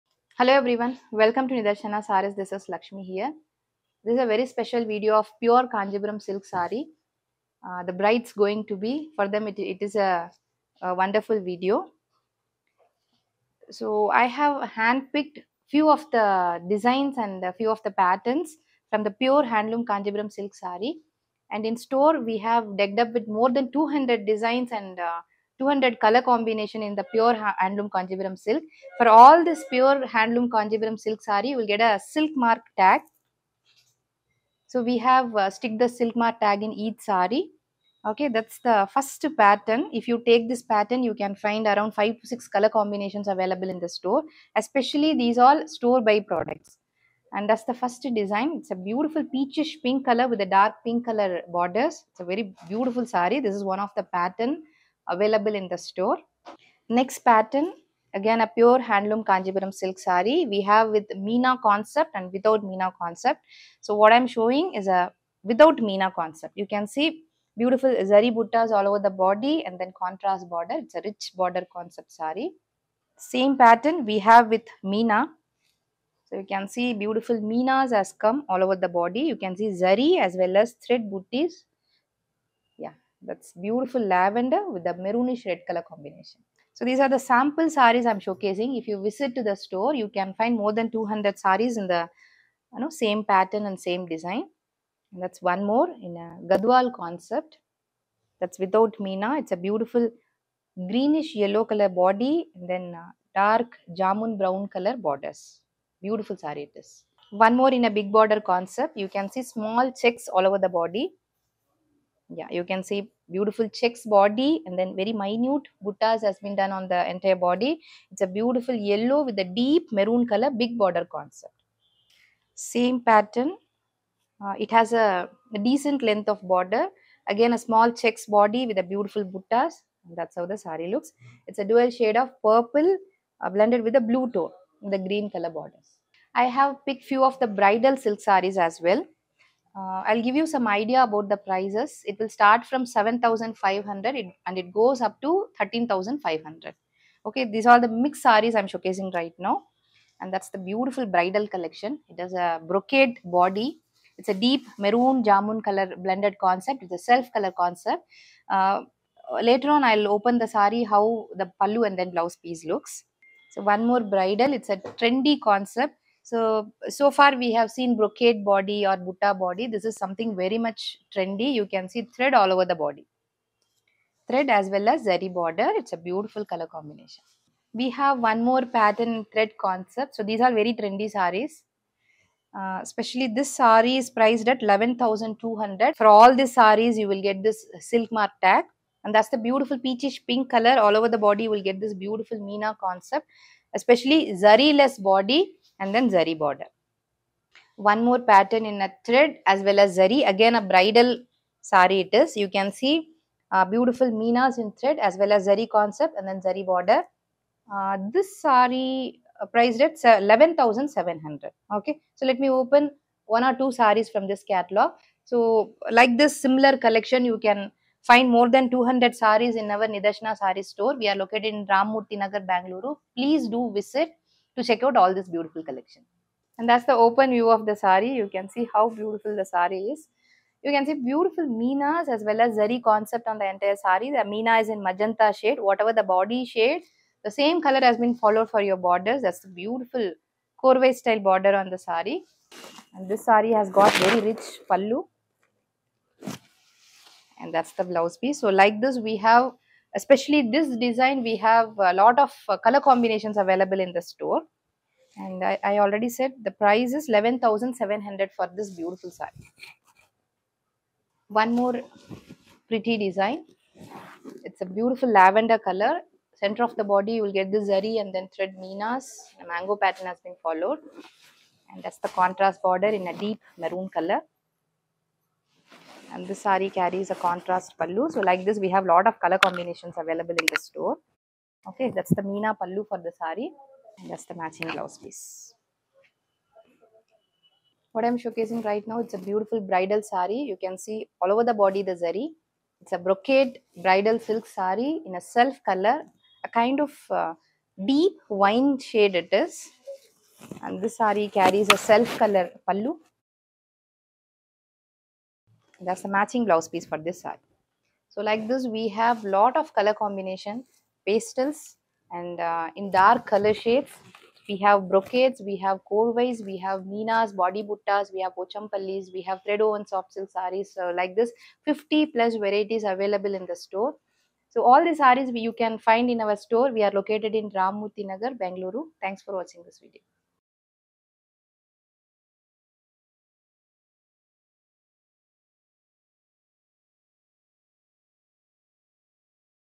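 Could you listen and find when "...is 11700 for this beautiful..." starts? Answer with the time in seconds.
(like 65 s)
256 s.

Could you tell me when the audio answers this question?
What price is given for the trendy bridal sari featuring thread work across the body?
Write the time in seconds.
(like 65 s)
184 s.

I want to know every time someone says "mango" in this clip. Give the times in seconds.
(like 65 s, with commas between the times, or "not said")
269 s.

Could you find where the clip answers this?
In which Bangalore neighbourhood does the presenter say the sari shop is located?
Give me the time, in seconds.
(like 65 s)
221 s.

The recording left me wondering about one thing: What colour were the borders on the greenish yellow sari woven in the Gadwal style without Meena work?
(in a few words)
dark jamun brown.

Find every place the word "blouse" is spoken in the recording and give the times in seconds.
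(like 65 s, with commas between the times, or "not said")
162 s, 247 s, 284 s, 306 s.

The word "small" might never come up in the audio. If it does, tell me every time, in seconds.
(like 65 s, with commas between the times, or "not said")
109 s, 127 s.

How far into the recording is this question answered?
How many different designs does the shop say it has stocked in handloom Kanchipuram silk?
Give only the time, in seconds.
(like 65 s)
23 s.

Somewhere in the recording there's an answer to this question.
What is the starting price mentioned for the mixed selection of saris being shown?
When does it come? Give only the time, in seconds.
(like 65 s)
142 s.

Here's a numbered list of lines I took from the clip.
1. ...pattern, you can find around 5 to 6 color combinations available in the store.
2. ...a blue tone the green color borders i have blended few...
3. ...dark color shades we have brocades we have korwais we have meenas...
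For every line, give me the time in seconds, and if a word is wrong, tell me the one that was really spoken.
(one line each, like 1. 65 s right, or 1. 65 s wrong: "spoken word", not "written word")
1. 40 s right
2. 133 s wrong: "picked", not "blended"
3. 312 s right.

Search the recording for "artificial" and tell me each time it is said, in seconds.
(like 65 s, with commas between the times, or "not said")
not said.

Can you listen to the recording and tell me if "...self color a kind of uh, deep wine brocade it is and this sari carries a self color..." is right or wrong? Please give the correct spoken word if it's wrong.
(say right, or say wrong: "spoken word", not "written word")
wrong: "shade", not "brocade".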